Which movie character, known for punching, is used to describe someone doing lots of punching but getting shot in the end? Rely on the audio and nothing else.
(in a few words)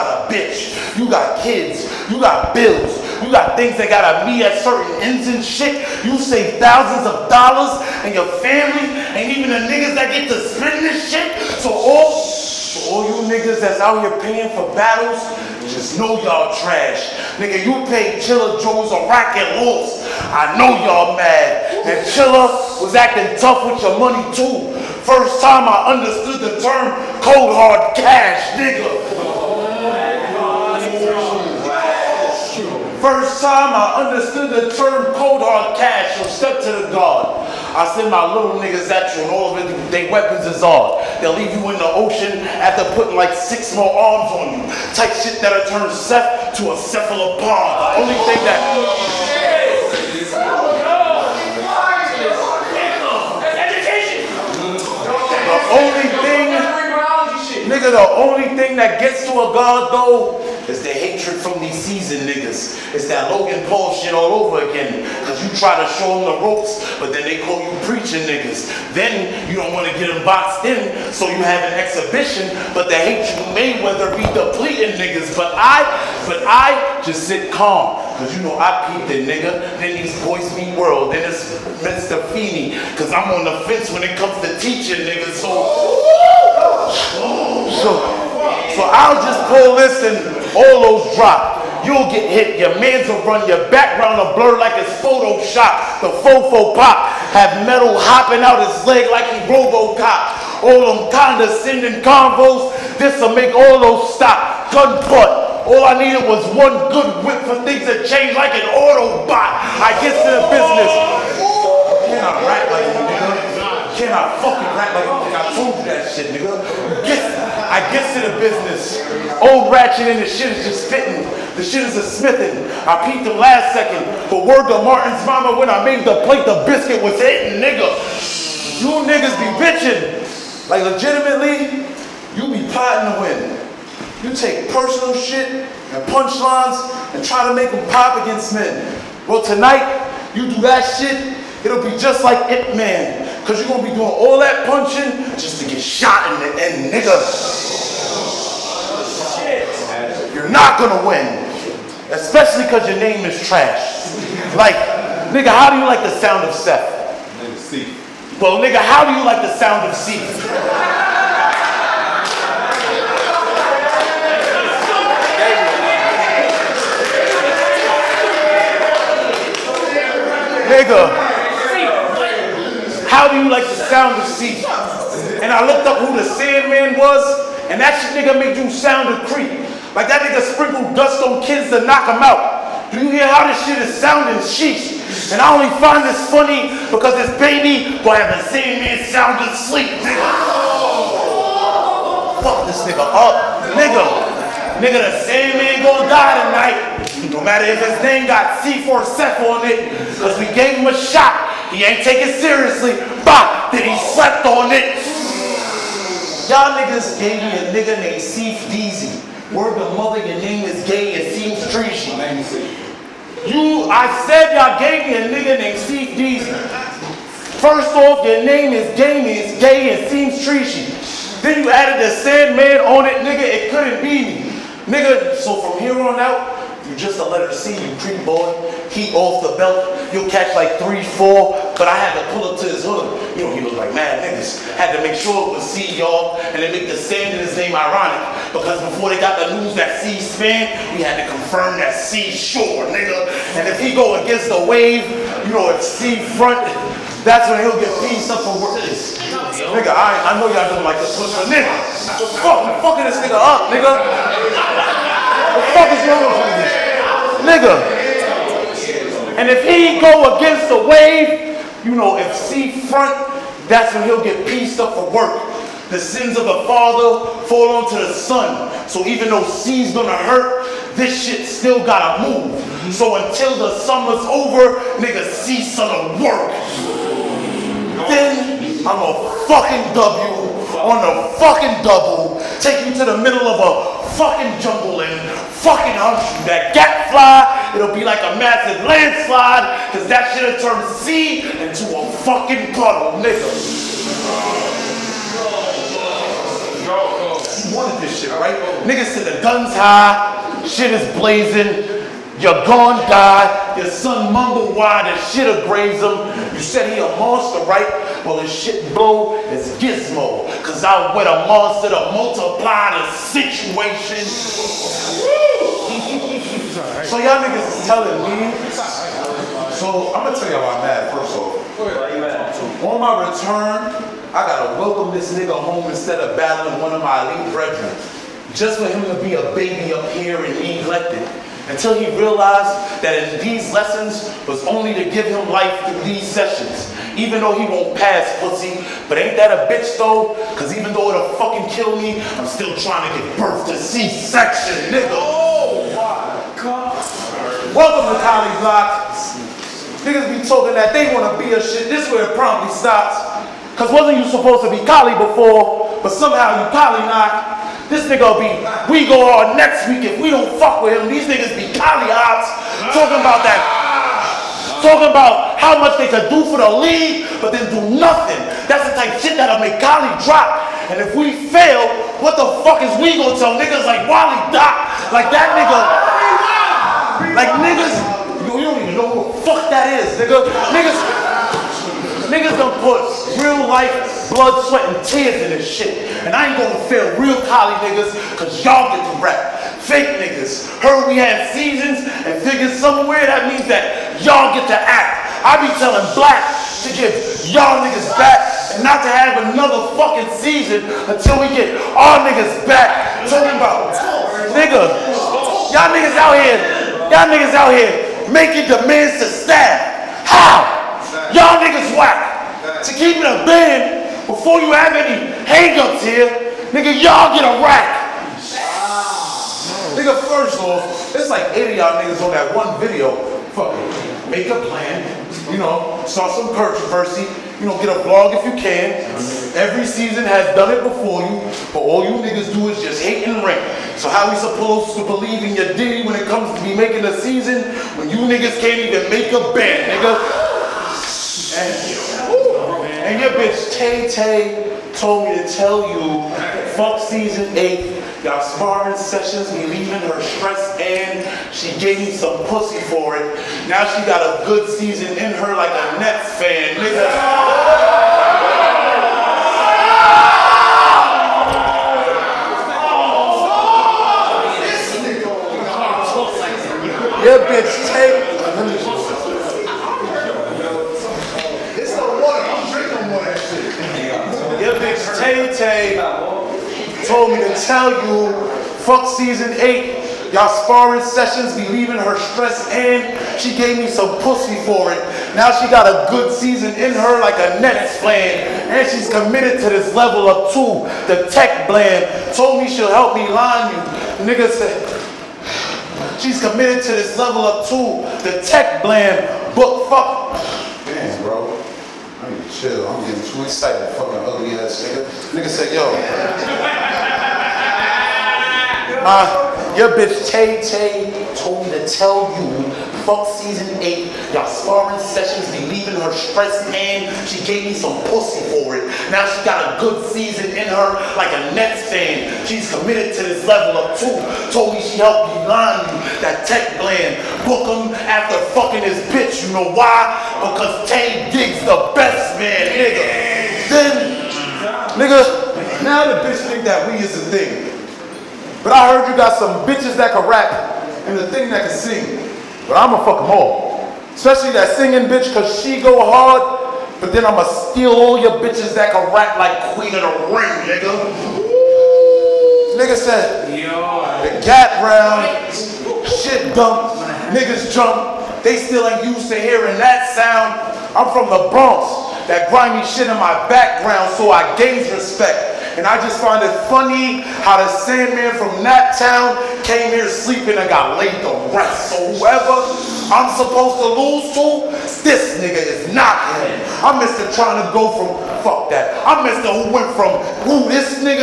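Ip Man.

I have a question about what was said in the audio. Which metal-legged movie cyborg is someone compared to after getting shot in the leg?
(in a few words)
Robocop.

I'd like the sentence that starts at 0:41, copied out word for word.
They'll leave you in the ocean after putting like six more arms on you.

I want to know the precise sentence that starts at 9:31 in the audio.
So whoever I'm supposed to lose to, this nigga is not him.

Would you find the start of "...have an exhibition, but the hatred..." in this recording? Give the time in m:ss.
1:11.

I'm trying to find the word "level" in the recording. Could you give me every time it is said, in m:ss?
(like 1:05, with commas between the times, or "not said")
8:09, 8:17, 8:43.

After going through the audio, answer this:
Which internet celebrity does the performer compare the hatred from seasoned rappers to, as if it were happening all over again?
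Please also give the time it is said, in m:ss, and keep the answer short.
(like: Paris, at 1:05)
Logan Paul, at 1:03.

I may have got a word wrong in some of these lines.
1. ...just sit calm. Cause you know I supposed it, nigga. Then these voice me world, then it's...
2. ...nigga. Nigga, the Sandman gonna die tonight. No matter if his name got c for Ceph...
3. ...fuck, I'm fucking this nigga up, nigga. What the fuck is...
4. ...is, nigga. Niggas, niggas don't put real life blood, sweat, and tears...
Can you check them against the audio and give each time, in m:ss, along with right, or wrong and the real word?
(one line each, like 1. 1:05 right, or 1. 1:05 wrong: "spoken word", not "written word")
1. 1:17 wrong: "peeped", not "supposed"
2. 3:13 right
3. 4:12 right
4. 6:20 right.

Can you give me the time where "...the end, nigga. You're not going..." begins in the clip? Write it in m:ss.
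2:26.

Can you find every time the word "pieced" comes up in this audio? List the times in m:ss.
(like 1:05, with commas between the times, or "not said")
4:08, 4:24.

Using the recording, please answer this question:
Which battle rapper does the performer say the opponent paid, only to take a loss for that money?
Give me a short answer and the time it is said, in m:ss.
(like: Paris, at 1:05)
Chilla Jones, at 0:18.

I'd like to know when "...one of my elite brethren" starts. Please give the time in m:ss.
5:26.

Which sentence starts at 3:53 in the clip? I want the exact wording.
You know, he was like mad niggas.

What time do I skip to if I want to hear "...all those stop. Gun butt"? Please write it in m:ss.
1:43.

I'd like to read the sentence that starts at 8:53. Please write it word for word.
Then, nigga, now the bitch think that we is the thing.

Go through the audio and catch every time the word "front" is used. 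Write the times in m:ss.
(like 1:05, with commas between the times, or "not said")
4:06, 4:22.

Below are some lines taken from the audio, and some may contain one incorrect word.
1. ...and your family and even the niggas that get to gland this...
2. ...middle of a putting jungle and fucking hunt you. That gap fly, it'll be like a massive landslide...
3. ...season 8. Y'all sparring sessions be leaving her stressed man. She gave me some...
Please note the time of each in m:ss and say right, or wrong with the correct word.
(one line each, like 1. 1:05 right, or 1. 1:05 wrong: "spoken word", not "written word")
1. 0:08 wrong: "spend", not "gland"
2. 4:43 wrong: "fucking", not "putting"
3. 8:33 right.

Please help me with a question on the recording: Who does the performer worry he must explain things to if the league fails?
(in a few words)
Wally Doc.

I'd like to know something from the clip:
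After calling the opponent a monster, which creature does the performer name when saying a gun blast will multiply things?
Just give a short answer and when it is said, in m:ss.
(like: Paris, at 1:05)
Gizmo, at 5:09.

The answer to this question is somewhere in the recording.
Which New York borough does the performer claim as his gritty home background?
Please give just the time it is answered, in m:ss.
9:21.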